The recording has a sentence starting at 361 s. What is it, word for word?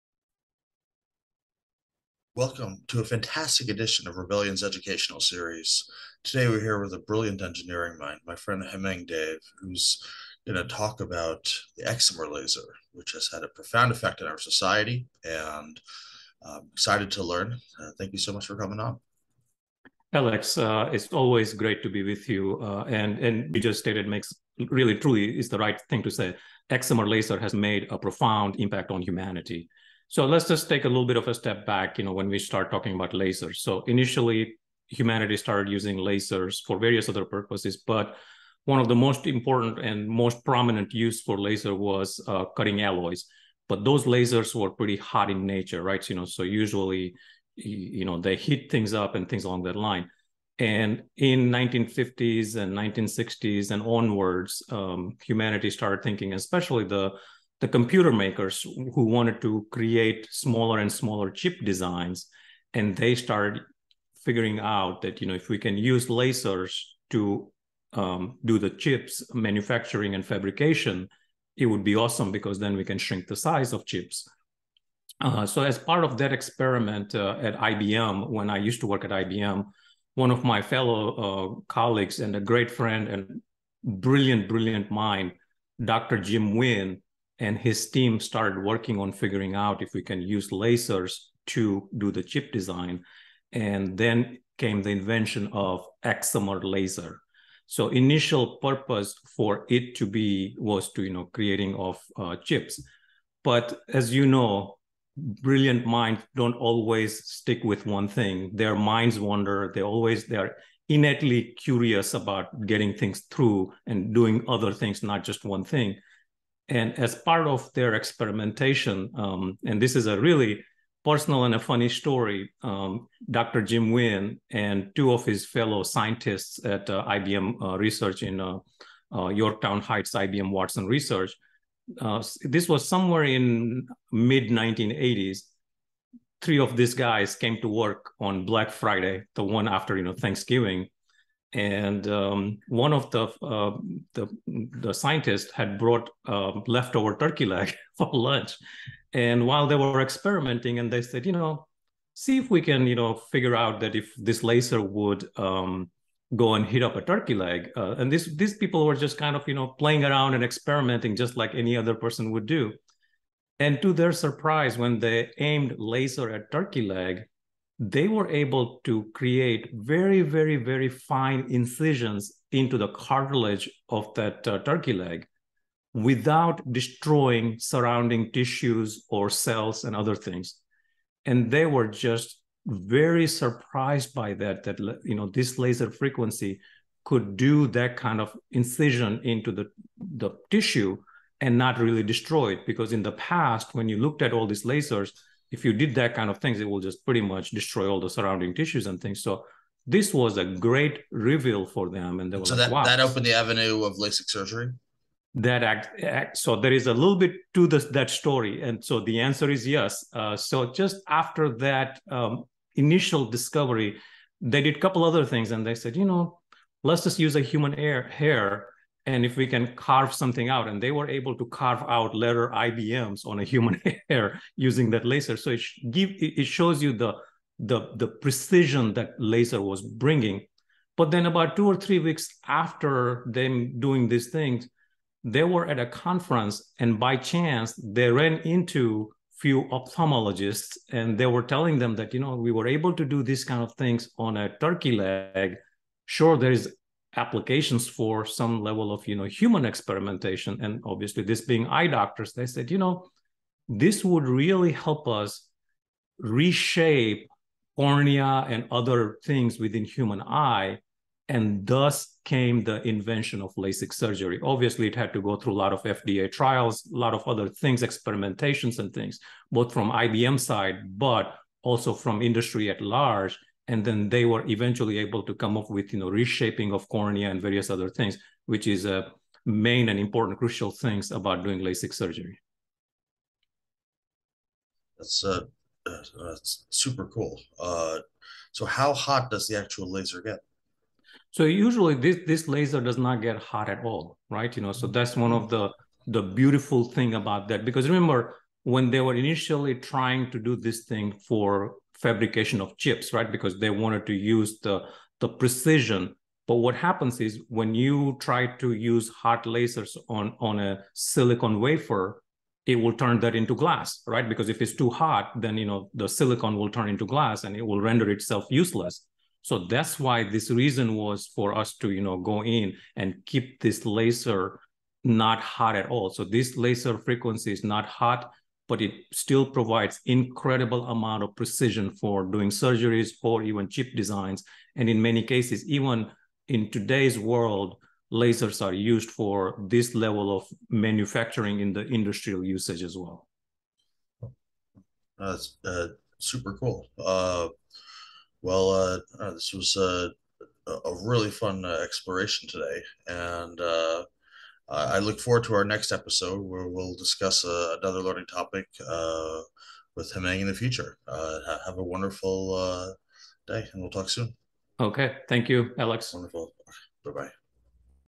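Uh, have a wonderful day and we'll talk soon.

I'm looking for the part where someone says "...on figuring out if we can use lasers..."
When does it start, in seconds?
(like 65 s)
88 s.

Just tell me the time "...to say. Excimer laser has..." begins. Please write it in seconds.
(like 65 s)
26 s.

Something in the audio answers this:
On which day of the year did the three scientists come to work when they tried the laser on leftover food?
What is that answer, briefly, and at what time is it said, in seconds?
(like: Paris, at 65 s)
Black Friday, at 138 s.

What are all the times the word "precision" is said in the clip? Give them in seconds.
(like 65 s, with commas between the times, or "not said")
228 s, 305 s, 331 s.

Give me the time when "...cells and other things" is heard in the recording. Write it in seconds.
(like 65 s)
179 s.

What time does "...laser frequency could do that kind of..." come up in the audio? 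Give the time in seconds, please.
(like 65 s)
185 s.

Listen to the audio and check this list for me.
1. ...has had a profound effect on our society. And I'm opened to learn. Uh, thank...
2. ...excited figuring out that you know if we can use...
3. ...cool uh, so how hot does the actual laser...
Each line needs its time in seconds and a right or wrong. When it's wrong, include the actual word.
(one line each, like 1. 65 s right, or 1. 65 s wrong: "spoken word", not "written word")
1. 13 s wrong: "excited", not "opened"
2. 63 s wrong: "started", not "excited"
3. 287 s right.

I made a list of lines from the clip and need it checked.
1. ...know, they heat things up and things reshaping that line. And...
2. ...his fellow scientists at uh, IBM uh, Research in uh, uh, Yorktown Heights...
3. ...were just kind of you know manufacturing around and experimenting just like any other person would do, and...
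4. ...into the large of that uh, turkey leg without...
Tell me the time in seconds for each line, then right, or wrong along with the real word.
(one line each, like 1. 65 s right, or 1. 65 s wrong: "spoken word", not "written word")
1. 48 s wrong: "along", not "reshaping"
2. 125 s right
3. 158 s wrong: "playing", not "manufacturing"
4. 172 s wrong: "cartilage", not "large".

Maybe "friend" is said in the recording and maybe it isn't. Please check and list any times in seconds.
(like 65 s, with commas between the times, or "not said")
8 s, 82 s.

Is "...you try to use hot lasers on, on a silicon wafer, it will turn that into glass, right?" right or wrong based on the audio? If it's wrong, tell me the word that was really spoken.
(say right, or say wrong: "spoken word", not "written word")
right.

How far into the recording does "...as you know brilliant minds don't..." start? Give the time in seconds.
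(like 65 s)
103 s.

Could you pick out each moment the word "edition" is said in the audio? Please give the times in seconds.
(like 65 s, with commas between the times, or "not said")
3 s.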